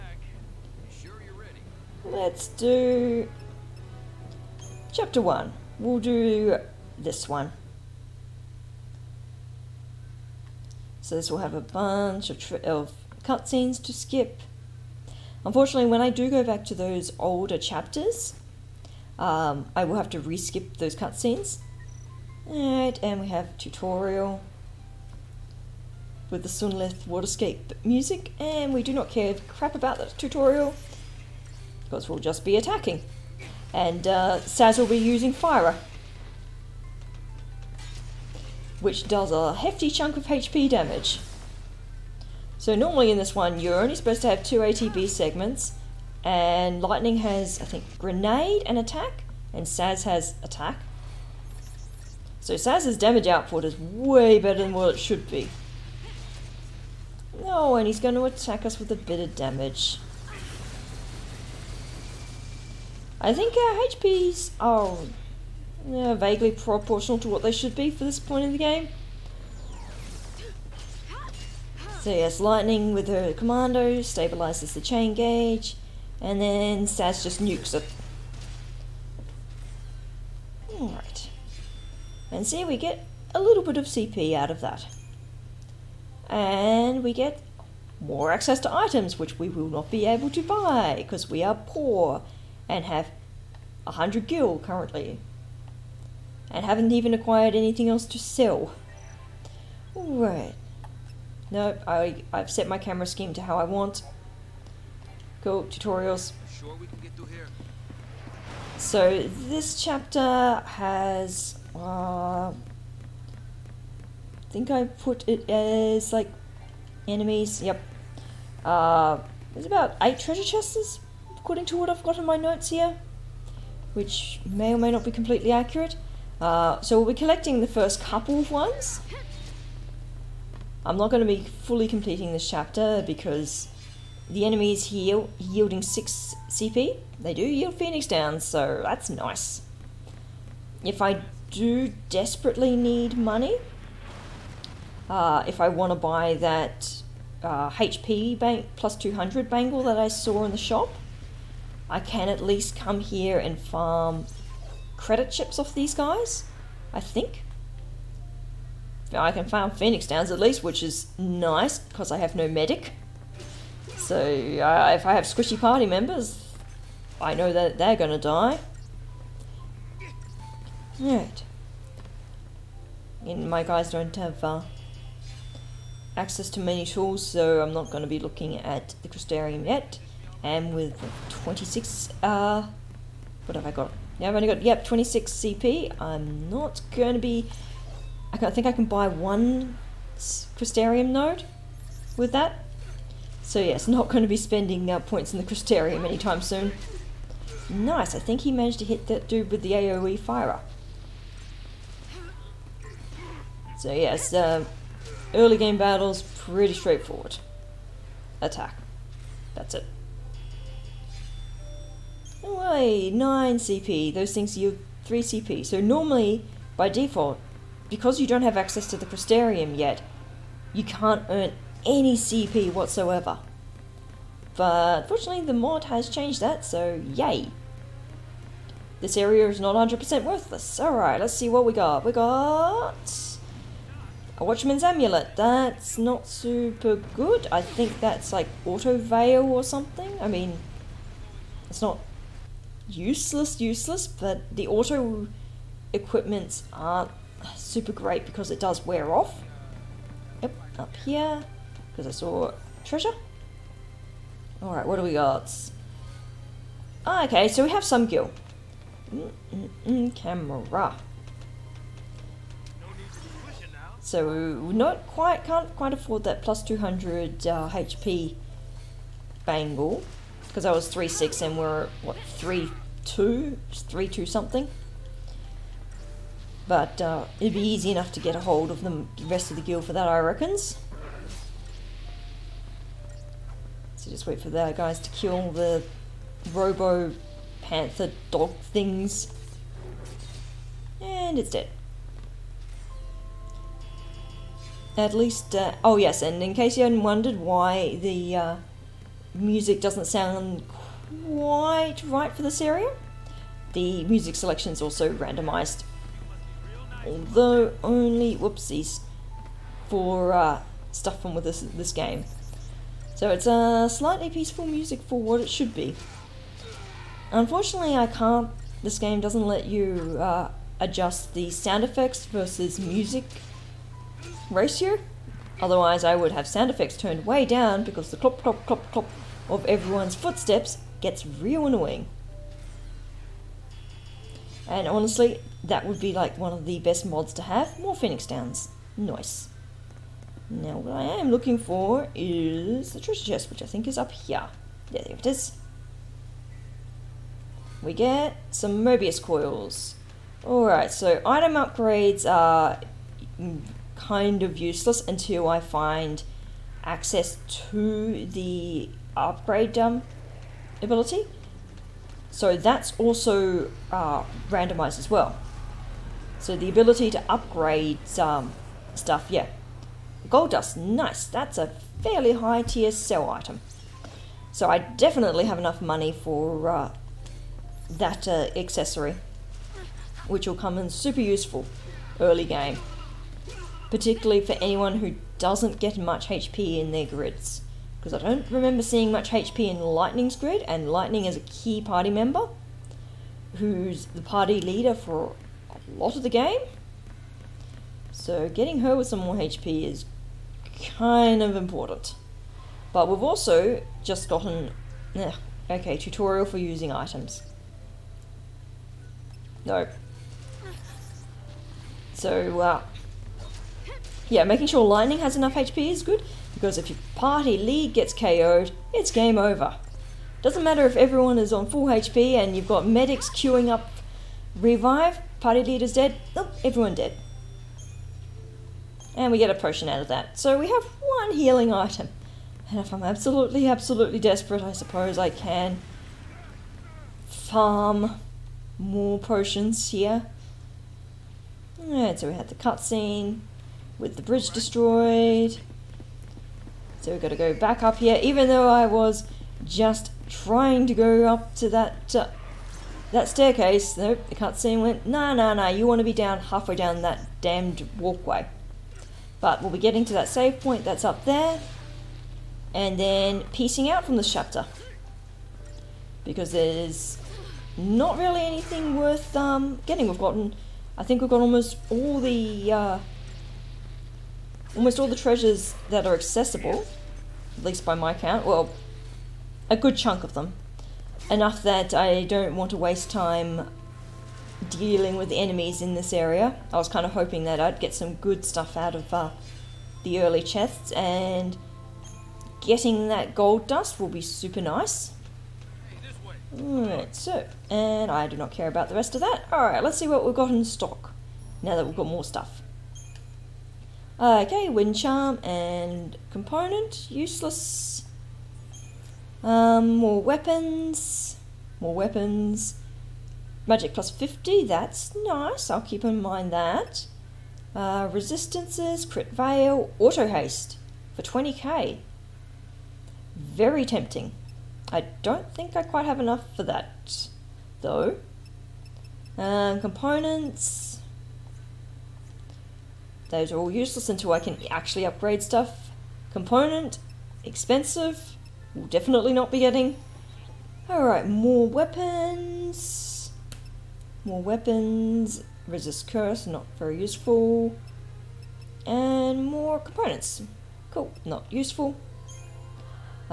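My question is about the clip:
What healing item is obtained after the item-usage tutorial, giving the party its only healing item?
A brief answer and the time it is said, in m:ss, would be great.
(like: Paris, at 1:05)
Potion, at 7:09.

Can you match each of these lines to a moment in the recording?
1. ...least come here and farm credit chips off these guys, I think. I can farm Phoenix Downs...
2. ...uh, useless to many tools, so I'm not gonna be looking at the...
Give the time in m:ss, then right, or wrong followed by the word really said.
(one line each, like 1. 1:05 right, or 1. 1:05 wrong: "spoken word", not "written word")
1. 2:32 right
2. 2:54 wrong: "access", not "useless".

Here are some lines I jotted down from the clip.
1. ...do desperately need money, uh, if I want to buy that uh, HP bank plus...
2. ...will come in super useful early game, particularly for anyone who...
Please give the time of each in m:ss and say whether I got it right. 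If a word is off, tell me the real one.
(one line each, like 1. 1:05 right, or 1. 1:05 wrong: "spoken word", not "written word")
1. 2:21 right
2. 6:20 right.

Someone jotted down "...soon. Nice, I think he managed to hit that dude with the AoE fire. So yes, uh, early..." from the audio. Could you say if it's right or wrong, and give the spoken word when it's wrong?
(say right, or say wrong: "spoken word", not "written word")
right.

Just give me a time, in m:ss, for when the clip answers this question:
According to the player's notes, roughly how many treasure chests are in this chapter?
2:00.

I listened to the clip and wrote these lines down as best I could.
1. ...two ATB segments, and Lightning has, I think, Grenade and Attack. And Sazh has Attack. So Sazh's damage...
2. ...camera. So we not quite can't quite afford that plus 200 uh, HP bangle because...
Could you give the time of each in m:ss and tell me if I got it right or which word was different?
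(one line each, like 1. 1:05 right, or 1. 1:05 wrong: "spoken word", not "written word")
1. 0:44 right
2. 4:20 right.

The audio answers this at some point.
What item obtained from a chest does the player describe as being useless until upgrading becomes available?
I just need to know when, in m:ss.
5:48.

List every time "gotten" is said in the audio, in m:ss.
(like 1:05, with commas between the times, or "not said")
6:44, 7:50.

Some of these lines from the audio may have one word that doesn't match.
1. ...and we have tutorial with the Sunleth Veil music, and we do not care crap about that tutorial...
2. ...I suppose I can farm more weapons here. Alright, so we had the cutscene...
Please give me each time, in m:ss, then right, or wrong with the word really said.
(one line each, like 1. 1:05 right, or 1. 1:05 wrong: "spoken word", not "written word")
1. 0:23 wrong: "Waterscape", not "Veil"
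2. 7:14 wrong: "potions", not "weapons".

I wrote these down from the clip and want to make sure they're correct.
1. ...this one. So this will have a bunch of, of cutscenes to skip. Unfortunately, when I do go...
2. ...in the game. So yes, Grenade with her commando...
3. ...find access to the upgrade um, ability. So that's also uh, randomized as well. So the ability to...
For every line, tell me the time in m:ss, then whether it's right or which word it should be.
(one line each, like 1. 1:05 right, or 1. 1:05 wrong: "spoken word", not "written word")
1. 0:06 right
2. 1:08 wrong: "Lightning", not "Grenade"
3. 5:55 right.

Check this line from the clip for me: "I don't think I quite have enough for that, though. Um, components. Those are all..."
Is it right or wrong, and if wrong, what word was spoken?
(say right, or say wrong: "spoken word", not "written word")
right.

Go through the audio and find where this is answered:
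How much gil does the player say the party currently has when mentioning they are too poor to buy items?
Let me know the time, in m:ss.
1:33.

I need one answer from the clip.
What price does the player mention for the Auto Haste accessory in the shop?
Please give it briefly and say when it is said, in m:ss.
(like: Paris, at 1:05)
20k, at 8:41.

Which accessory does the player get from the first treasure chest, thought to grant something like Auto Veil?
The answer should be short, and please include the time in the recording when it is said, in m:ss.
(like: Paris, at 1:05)
Watchman's Amulet, at 3:54.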